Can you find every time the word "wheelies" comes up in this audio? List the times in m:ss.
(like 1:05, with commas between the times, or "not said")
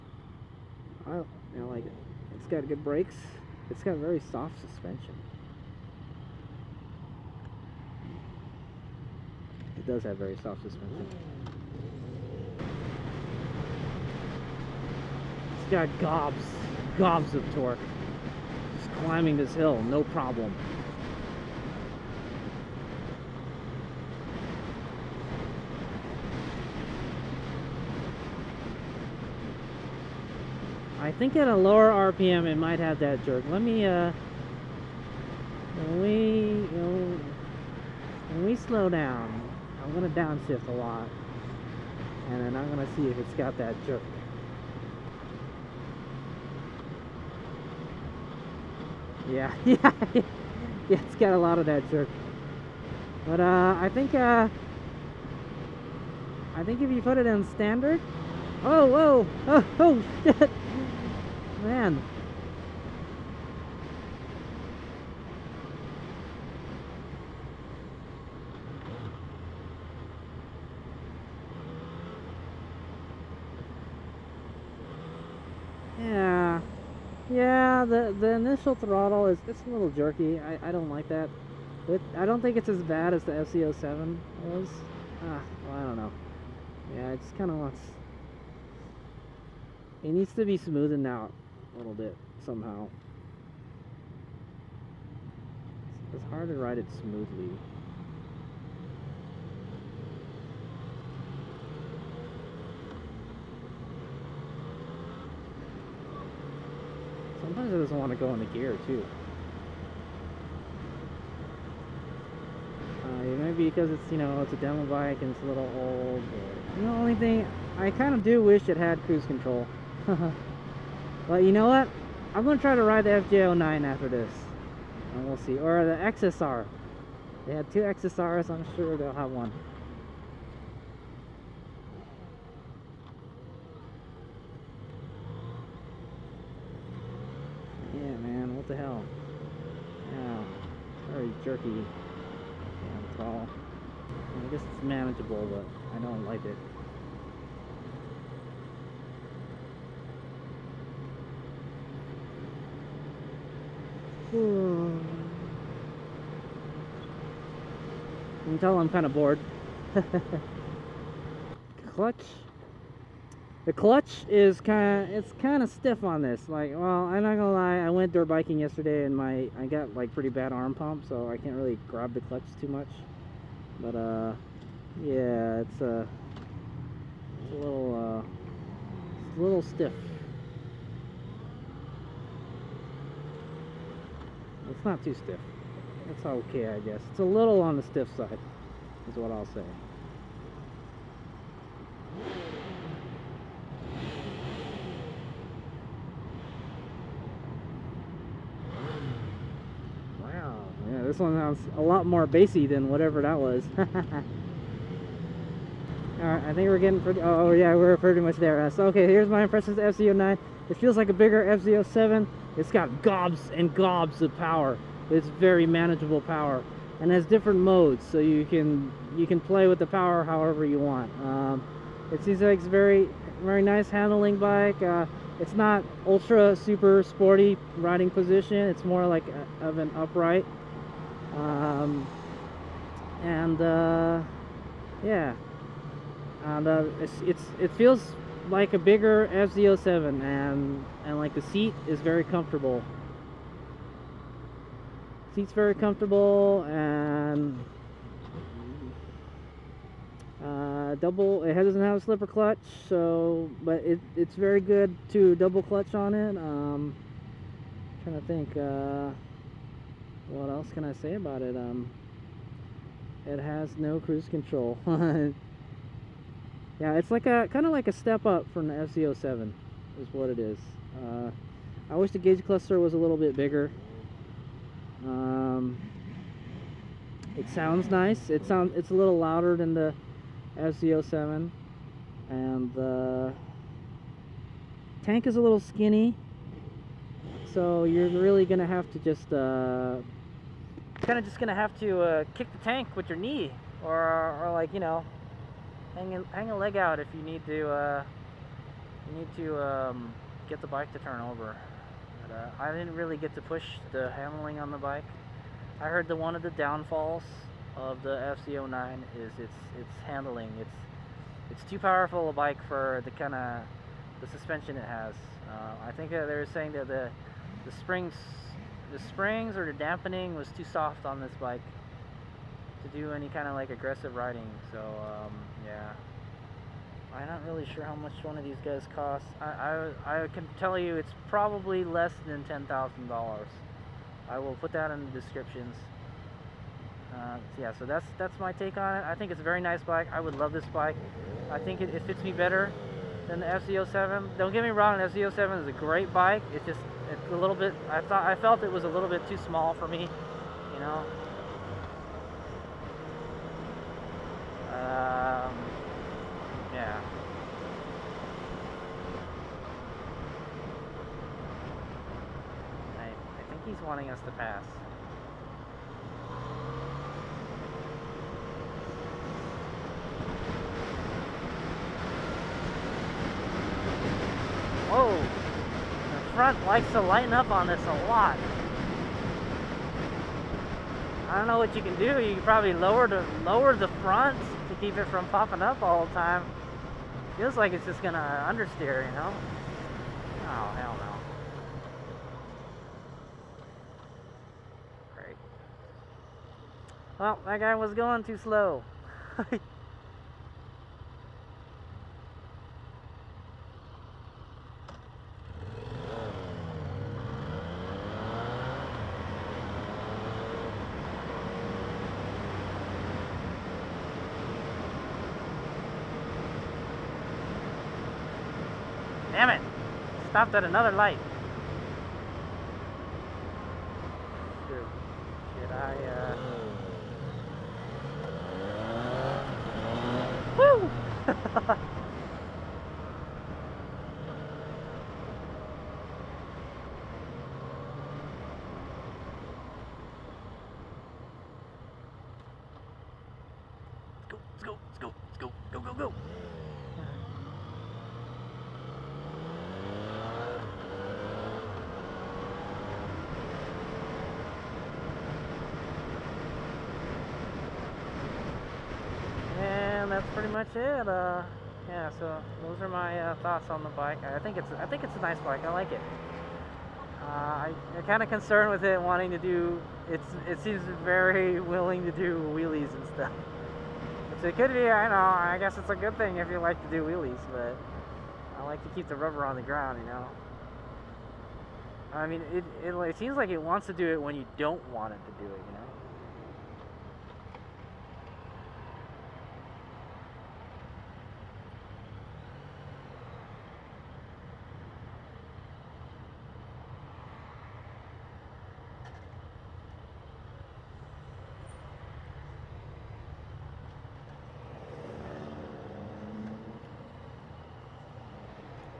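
7:52, 7:57.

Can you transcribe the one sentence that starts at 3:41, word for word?
Um, it seems like it's very very nice handling bike.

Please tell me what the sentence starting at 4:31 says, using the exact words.
Uh, I wish the gauge cluster was a little bit bigger.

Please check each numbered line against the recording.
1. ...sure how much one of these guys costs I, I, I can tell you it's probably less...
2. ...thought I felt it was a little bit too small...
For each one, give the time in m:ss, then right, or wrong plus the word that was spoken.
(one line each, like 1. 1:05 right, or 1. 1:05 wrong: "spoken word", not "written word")
1. 5:27 right
2. 5:48 right.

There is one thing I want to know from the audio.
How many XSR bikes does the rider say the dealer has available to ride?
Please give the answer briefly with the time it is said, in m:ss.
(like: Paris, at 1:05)
2, at 2:07.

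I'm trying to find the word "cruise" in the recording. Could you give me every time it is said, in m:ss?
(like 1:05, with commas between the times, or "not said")
1:59, 4:23.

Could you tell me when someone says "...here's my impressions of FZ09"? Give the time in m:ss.
3:29.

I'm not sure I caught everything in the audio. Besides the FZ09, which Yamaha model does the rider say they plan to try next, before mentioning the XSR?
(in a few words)
FJ09.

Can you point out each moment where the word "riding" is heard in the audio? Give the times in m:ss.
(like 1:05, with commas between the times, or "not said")
3:47, 5:24.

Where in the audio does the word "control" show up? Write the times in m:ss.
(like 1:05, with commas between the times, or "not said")
1:59, 4:24.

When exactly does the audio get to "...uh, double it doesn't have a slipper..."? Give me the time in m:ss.
4:10.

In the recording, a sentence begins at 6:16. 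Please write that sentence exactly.
front likes to lighten up on this a lot.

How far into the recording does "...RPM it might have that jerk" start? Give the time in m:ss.
0:32.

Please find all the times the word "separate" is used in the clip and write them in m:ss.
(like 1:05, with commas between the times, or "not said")
not said.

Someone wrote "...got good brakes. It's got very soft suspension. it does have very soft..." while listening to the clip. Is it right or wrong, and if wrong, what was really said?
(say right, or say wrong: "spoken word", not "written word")
right.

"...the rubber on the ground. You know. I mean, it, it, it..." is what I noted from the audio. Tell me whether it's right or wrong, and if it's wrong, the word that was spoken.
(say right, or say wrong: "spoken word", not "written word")
right.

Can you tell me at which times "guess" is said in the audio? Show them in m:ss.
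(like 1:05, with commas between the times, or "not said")
2:24, 3:06, 7:55.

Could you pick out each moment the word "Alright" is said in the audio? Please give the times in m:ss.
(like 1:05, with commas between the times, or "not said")
3:23.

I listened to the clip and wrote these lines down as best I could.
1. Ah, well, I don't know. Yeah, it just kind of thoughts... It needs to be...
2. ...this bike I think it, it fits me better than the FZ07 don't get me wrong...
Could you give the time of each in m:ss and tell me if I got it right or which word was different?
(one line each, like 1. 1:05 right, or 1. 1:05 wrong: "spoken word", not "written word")
1. 1:25 wrong: "wants", not "thoughts"
2. 5:40 right.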